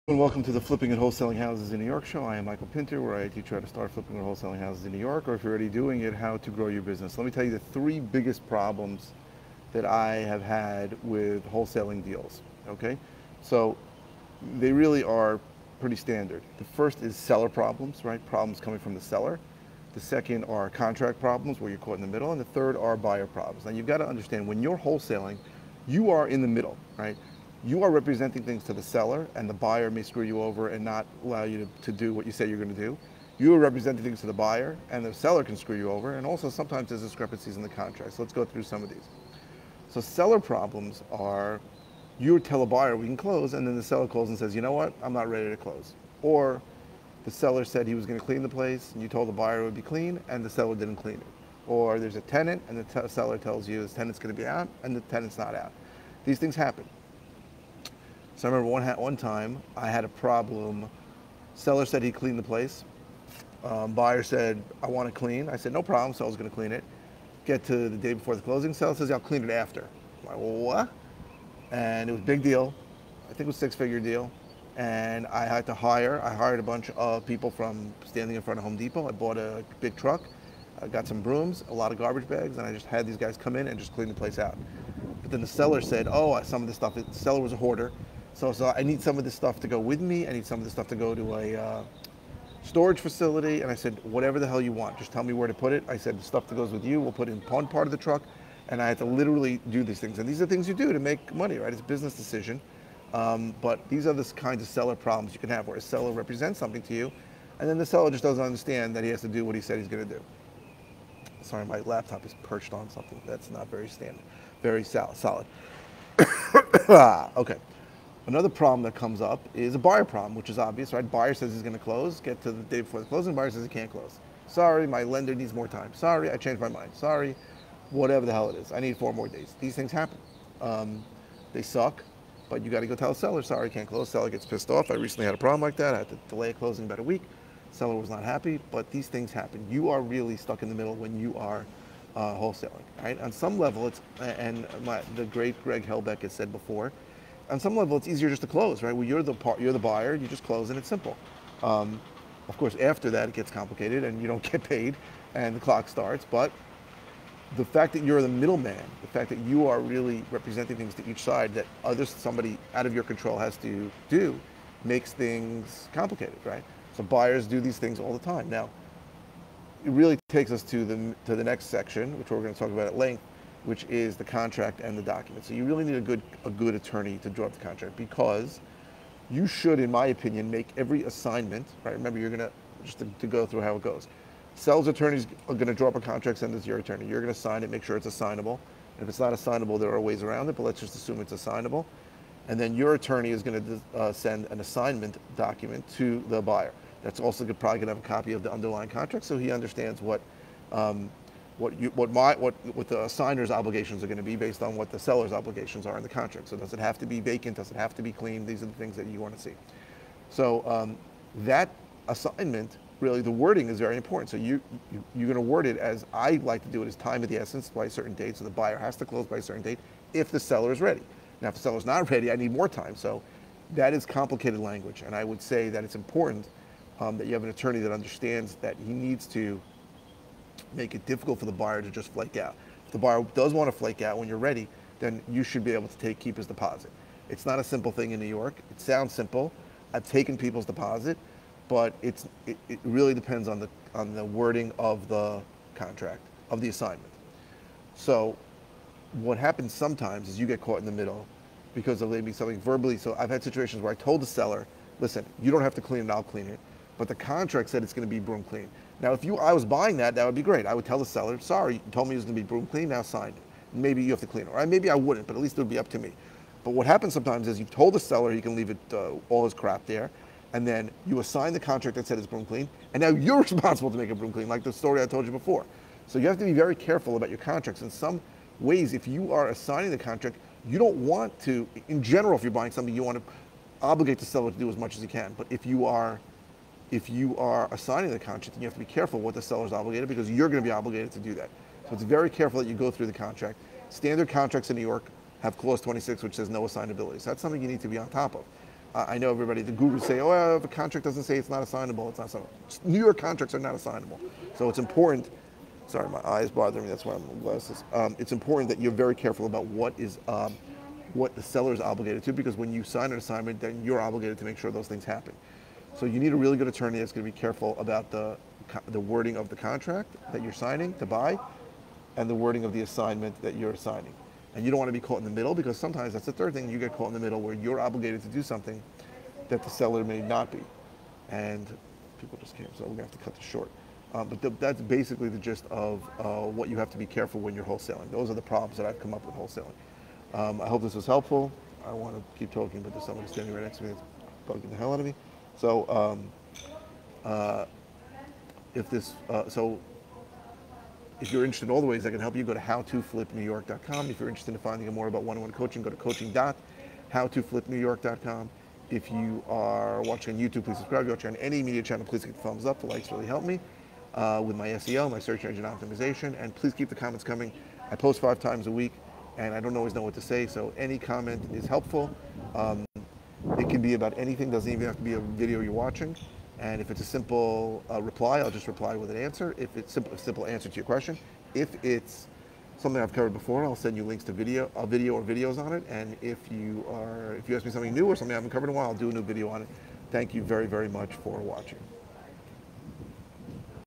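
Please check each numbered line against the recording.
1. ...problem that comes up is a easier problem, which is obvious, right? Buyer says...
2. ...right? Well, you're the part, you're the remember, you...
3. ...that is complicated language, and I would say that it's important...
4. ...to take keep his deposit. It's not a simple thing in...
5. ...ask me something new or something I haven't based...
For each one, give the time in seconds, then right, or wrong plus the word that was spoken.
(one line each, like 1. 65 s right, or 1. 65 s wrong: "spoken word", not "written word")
1. 118 s wrong: "buyer", not "easier"
2. 148 s wrong: "buyer", not "remember"
3. 223 s right
4. 235 s right
5. 387 s wrong: "covered", not "based".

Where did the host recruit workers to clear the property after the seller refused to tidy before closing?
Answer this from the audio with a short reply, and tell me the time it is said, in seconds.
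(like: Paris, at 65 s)
In front of Home Depot, at 78 s.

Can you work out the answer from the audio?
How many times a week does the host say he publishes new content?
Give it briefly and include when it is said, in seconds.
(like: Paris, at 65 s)
5, at 368 s.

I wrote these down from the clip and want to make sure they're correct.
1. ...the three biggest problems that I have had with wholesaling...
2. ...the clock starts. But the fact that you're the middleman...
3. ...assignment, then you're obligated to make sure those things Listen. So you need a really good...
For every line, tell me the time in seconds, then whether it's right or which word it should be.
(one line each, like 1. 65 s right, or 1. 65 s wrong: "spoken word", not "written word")
1. 7 s right
2. 155 s right
3. 313 s wrong: "happen", not "Listen".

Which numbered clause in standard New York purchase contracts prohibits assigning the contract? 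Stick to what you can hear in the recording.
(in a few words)
Clause 26.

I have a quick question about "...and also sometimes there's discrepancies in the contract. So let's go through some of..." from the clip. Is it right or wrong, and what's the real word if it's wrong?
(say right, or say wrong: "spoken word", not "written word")
right.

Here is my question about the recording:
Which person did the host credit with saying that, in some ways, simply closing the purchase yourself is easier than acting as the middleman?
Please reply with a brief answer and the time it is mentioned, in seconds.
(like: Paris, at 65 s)
Greg Helbeck, at 145 s.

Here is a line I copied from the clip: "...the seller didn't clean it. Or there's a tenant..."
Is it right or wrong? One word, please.
right.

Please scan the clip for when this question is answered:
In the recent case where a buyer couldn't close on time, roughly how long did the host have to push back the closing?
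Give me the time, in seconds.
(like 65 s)
136 s.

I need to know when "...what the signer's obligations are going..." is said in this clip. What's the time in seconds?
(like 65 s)
202 s.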